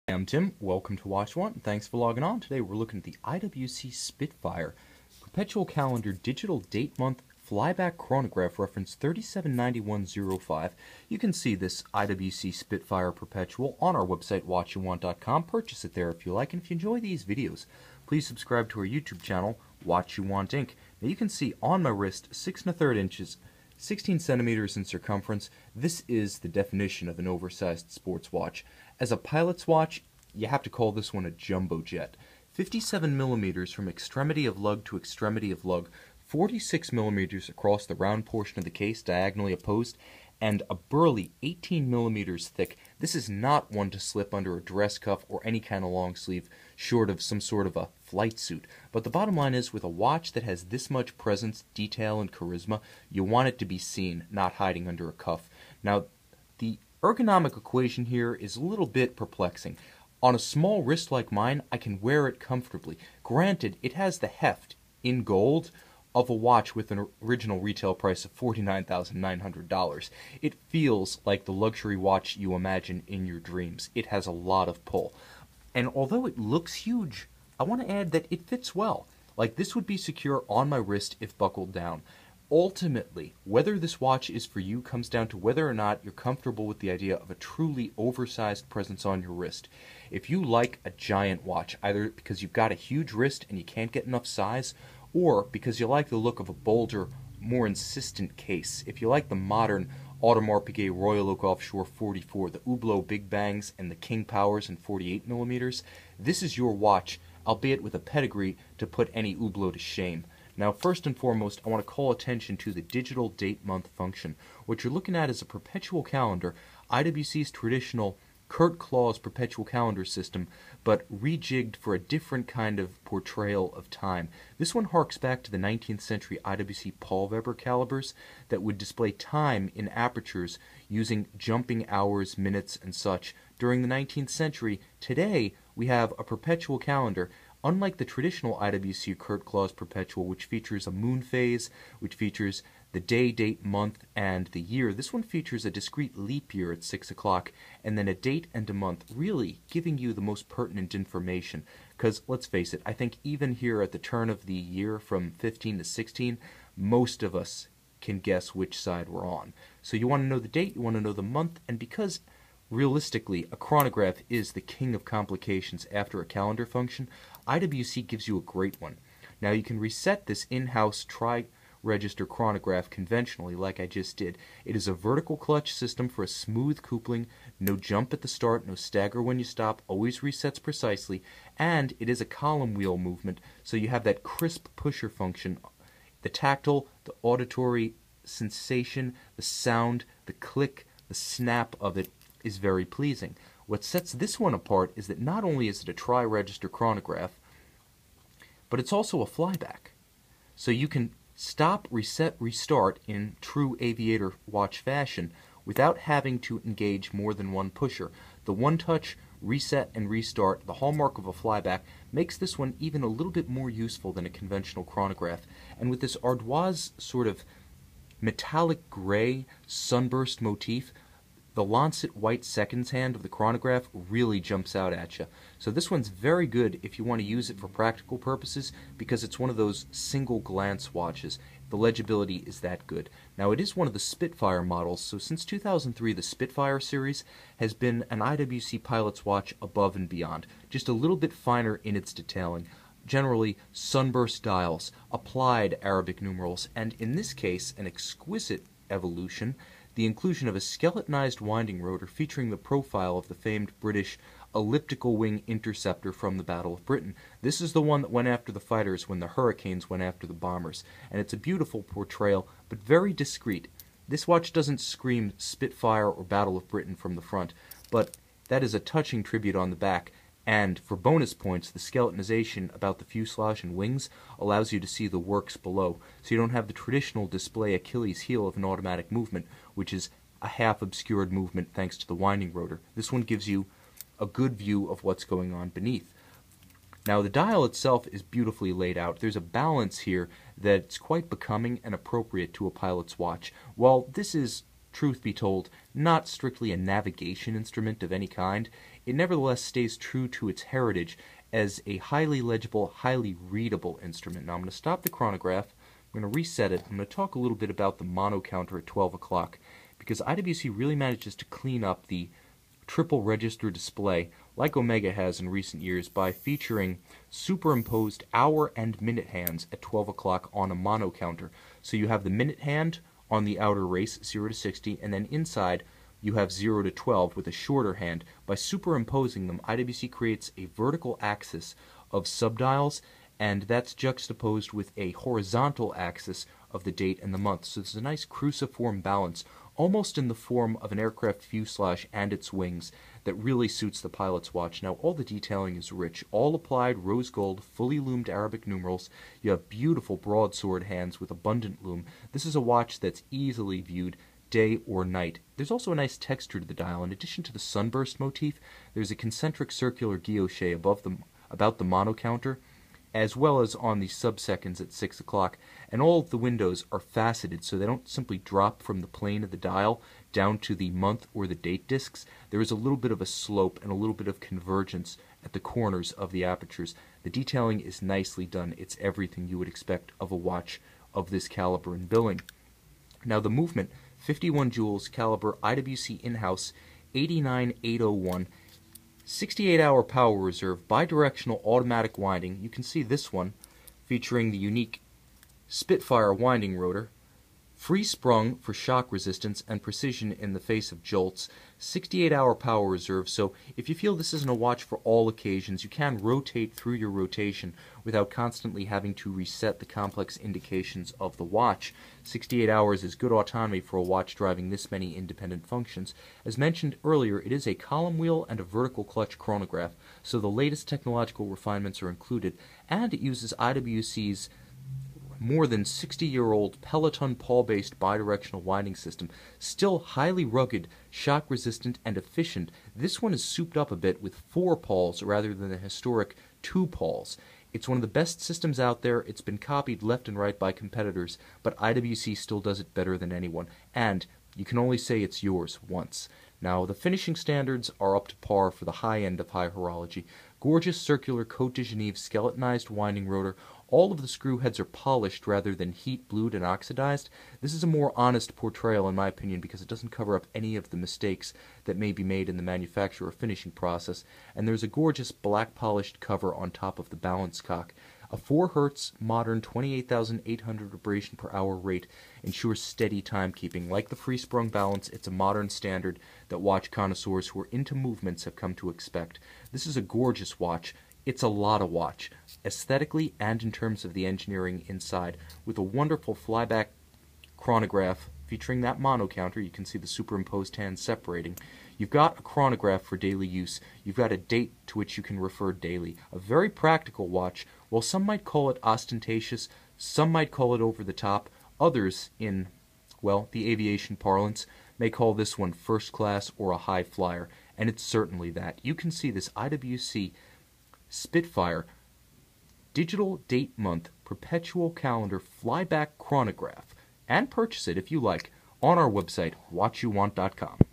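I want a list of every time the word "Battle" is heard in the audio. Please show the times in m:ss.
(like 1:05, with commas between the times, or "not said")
4:16, 4:26.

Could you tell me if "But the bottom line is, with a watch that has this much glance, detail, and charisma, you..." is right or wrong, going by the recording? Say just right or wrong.
wrong.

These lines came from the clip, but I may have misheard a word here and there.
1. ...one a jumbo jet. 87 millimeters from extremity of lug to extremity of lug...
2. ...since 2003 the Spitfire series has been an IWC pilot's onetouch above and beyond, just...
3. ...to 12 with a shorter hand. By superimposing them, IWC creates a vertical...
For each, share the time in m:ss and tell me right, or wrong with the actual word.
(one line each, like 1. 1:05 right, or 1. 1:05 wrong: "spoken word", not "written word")
1. 0:31 wrong: "57", not "87"
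2. 3:55 wrong: "watch", not "onetouch"
3. 5:26 right.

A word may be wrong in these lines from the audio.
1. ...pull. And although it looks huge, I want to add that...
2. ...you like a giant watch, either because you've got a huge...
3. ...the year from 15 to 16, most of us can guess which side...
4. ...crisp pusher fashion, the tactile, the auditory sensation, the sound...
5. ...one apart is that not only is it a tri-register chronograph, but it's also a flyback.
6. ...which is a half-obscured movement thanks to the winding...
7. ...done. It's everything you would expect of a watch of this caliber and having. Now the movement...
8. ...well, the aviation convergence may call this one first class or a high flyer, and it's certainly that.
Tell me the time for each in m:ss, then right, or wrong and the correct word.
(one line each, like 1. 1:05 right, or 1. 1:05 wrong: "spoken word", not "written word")
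1. 1:14 right
2. 1:30 right
3. 2:34 right
4. 3:04 wrong: "function", not "fashion"
5. 3:14 right
6. 4:39 right
7. 6:18 wrong: "billing", not "having"
8. 8:23 wrong: "parlance", not "convergence".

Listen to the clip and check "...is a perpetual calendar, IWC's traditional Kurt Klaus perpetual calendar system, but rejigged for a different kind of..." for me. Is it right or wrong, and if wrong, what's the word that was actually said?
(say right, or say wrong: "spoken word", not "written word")
right.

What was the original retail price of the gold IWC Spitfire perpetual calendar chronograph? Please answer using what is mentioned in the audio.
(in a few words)
$49,900.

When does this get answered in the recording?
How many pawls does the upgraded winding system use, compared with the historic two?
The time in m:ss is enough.
7:14.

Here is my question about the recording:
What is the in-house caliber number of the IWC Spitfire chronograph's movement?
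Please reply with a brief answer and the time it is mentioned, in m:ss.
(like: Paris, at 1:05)
89801, at 6:27.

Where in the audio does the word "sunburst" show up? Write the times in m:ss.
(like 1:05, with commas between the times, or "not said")
3:39, 4:03, 5:57.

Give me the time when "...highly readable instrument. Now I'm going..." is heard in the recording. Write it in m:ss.
5:02.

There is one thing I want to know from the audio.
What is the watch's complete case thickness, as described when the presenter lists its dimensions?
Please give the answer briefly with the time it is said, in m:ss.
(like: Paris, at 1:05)
18 millimeters, at 0:41.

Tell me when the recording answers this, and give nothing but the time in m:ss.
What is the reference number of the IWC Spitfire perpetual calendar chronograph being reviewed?
0:08.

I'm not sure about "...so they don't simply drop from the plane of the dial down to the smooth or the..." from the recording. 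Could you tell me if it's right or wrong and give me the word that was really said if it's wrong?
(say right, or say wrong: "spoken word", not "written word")
wrong: "month", not "smooth".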